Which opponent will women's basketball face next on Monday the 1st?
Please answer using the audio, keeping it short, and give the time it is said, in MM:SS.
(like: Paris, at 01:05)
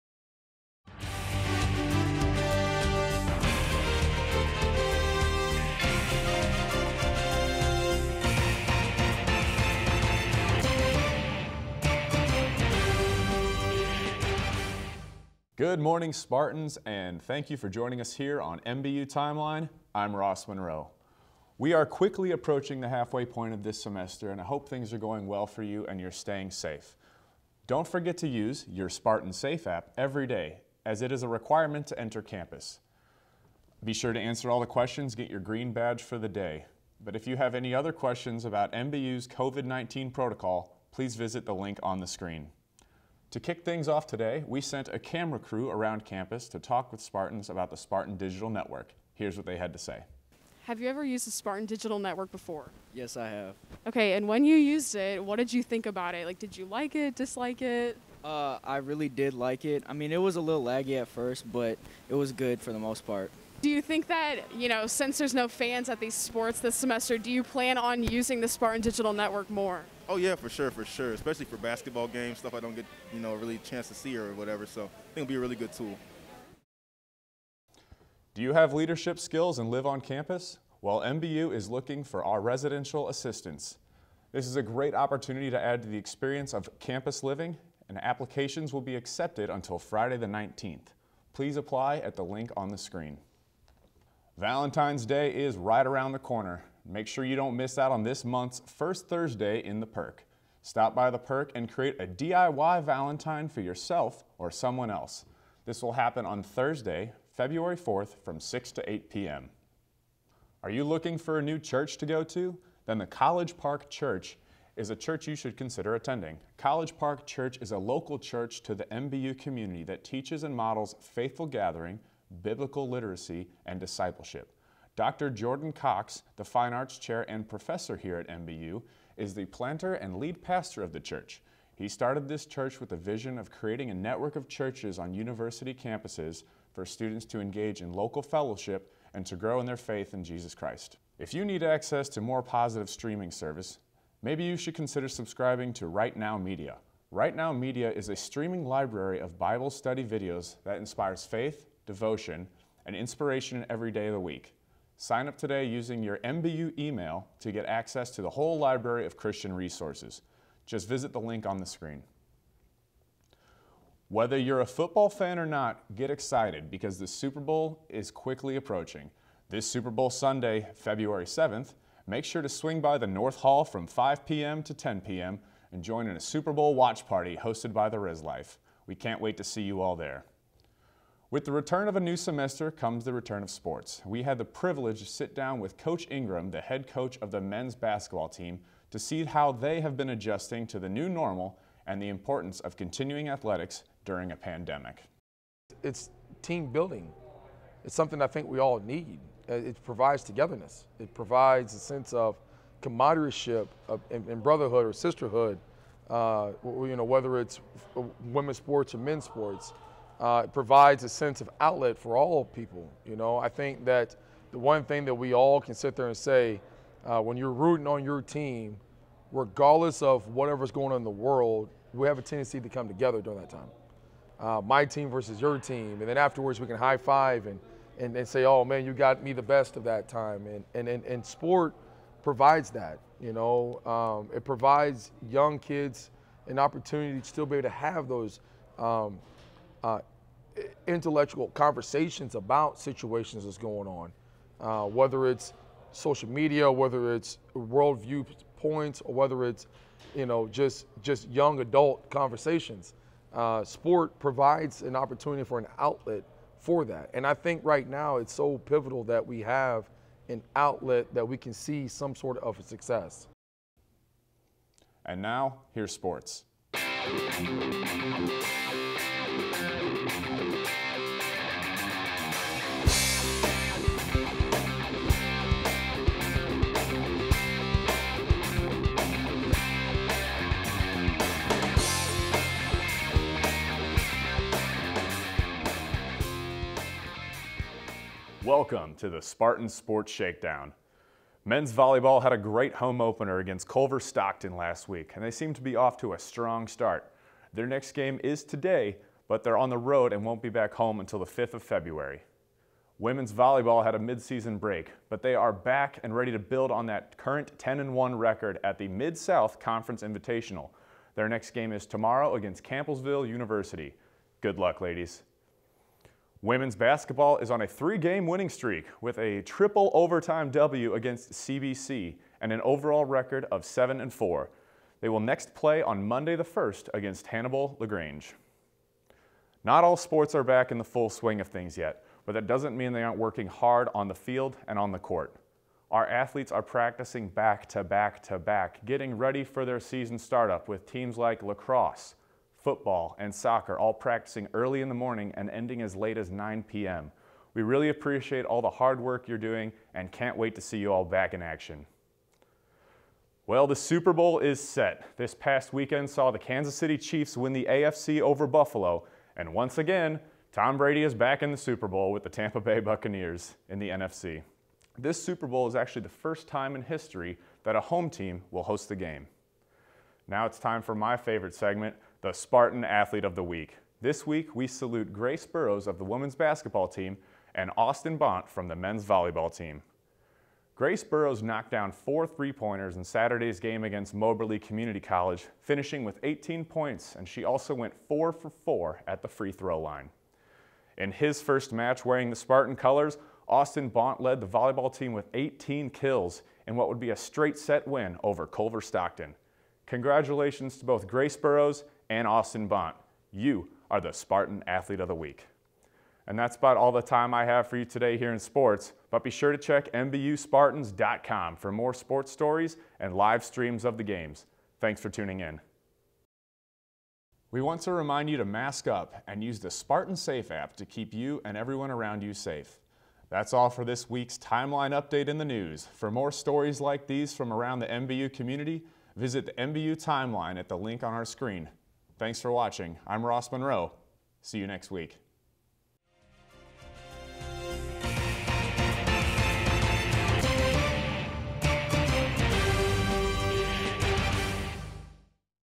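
Hannibal LaGrange, at 05:27.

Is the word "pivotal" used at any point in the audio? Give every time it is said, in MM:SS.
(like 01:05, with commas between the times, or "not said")
04:18.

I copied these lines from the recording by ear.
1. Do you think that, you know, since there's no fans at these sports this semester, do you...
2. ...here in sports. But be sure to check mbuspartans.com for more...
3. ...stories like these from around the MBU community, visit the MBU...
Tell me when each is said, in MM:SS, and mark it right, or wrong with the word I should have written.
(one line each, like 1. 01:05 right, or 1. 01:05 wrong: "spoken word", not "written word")
1. 01:03 right
2. 06:48 right
3. 07:06 right.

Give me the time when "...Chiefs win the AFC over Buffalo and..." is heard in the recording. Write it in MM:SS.
05:56.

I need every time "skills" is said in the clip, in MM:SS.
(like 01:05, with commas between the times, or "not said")
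01:19.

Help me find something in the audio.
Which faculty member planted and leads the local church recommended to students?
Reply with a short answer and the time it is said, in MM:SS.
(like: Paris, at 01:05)
Dr. Jordan Cox, at 02:04.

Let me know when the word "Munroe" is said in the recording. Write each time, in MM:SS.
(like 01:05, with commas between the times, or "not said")
00:20, 07:13.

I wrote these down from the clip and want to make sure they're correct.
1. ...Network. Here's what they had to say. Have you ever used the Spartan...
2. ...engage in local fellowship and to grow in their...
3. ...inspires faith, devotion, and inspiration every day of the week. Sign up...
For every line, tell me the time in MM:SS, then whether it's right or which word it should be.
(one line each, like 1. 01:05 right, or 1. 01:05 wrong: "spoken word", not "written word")
1. 00:48 right
2. 02:17 right
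3. 02:30 right.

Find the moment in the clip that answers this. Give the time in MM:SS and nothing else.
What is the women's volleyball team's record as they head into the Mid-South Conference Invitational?
05:07.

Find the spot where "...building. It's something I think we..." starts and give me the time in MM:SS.
03:16.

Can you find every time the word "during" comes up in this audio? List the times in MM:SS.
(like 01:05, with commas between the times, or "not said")
03:14, 03:43.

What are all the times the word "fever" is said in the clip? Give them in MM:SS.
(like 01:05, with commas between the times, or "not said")
not said.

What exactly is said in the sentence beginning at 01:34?
Valentine's Day is right around the corner.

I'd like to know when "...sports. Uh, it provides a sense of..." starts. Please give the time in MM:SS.
03:29.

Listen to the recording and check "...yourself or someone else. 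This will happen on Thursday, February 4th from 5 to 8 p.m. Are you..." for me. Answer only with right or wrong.
wrong.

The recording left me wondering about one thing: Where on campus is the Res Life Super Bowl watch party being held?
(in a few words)
North Hall.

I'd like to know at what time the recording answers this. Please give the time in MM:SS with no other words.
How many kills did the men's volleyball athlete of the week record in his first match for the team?
06:35.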